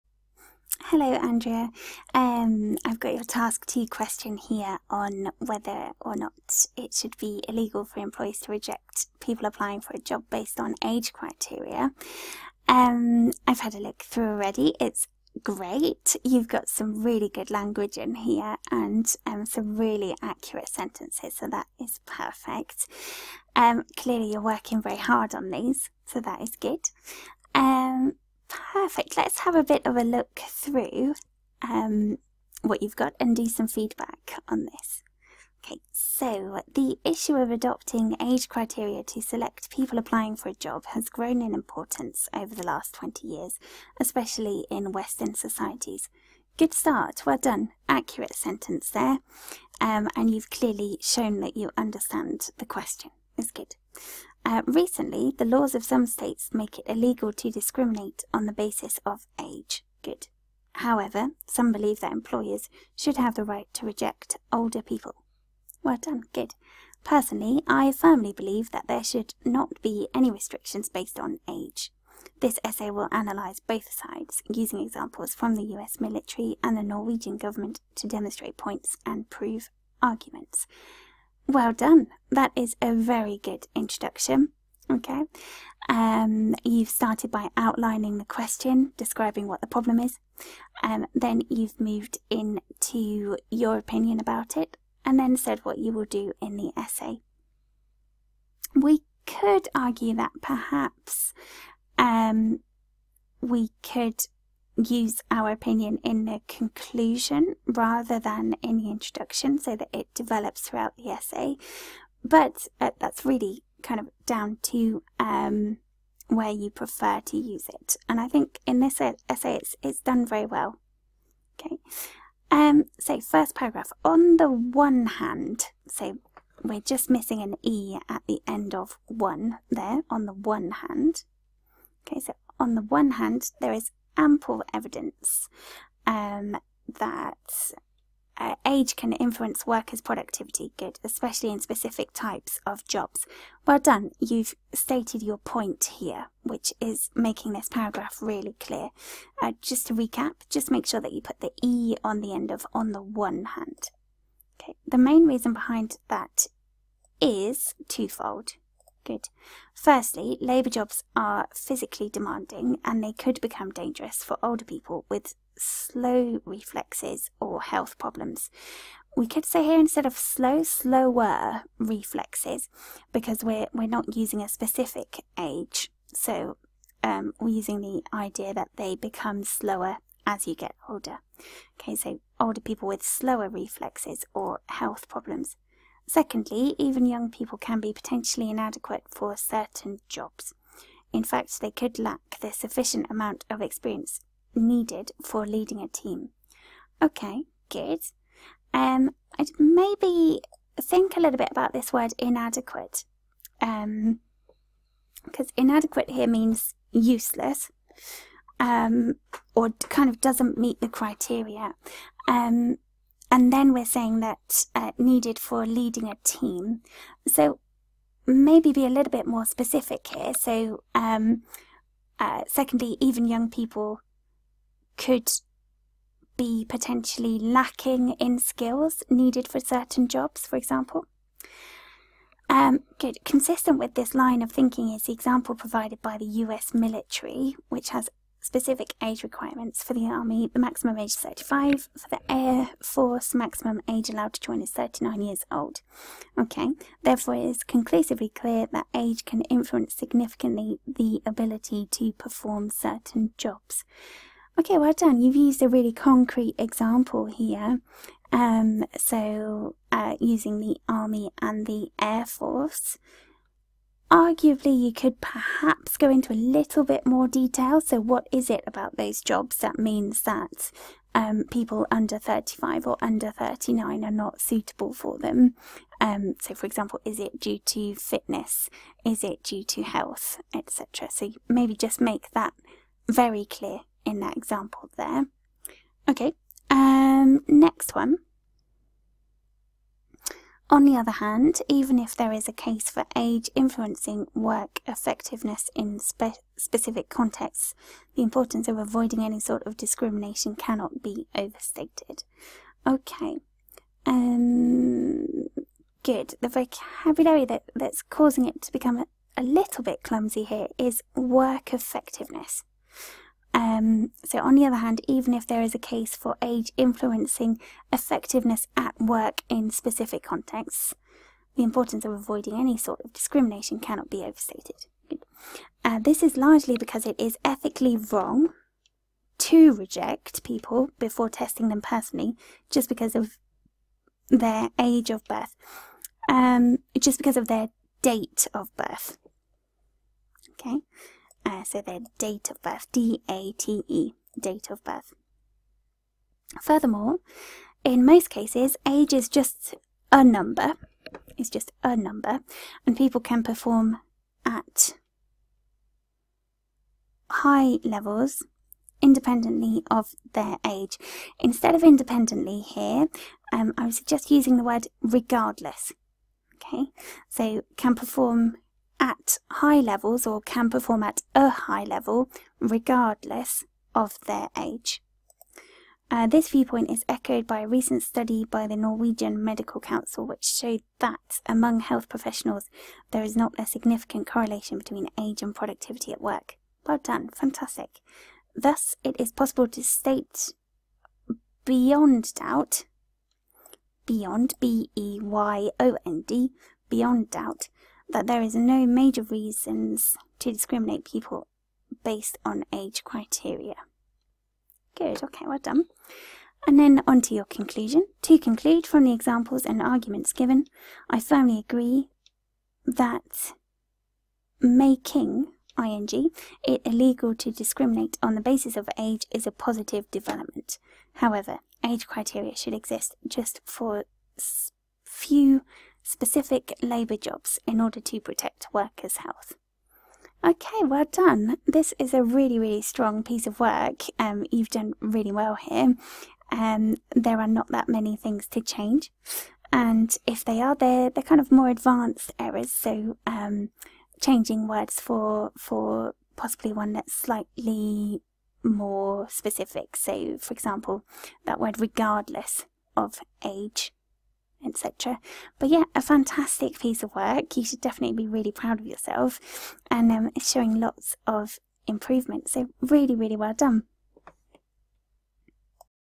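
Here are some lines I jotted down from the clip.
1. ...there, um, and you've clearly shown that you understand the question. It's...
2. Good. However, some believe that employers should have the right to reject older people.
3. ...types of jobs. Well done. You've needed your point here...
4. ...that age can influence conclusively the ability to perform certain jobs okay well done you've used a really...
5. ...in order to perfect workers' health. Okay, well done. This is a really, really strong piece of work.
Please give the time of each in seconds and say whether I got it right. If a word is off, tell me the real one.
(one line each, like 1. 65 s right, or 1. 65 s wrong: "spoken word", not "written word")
1. 48 s right
2. 60 s right
3. 142 s wrong: "stated", not "needed"
4. 248 s wrong: "significantly", not "conclusively"
5. 427 s wrong: "protect", not "perfect".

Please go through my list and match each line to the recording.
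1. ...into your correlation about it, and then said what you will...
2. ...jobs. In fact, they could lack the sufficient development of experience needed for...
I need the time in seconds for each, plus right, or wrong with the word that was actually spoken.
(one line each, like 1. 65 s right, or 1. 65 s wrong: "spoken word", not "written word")
1. 92 s wrong: "opinion", not "correlation"
2. 190 s wrong: "amount", not "development".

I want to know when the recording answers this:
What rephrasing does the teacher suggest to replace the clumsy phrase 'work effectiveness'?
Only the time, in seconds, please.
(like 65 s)
317 s.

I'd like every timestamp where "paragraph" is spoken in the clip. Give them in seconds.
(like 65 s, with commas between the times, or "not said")
123 s, 147 s.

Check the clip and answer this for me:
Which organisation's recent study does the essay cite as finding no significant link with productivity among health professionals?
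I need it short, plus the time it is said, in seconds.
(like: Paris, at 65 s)
Norwegian Medical Council, at 378 s.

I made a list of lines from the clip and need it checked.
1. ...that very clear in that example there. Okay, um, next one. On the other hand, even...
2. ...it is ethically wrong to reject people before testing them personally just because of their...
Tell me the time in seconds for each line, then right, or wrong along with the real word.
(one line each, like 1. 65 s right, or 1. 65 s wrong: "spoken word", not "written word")
1. 282 s right
2. 327 s right.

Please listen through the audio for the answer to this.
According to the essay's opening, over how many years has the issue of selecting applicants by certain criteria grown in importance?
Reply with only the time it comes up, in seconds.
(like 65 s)
42 s.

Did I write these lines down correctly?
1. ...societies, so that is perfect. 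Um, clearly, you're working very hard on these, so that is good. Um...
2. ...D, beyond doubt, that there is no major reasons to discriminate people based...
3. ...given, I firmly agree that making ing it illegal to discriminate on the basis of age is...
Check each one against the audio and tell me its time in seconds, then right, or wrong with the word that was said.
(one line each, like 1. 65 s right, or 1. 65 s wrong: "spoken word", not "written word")
1. 20 s wrong: "sentences", not "societies"
2. 396 s right
3. 410 s right.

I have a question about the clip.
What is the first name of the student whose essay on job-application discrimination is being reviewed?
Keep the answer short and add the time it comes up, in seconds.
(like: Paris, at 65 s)
Andrea, at 1 s.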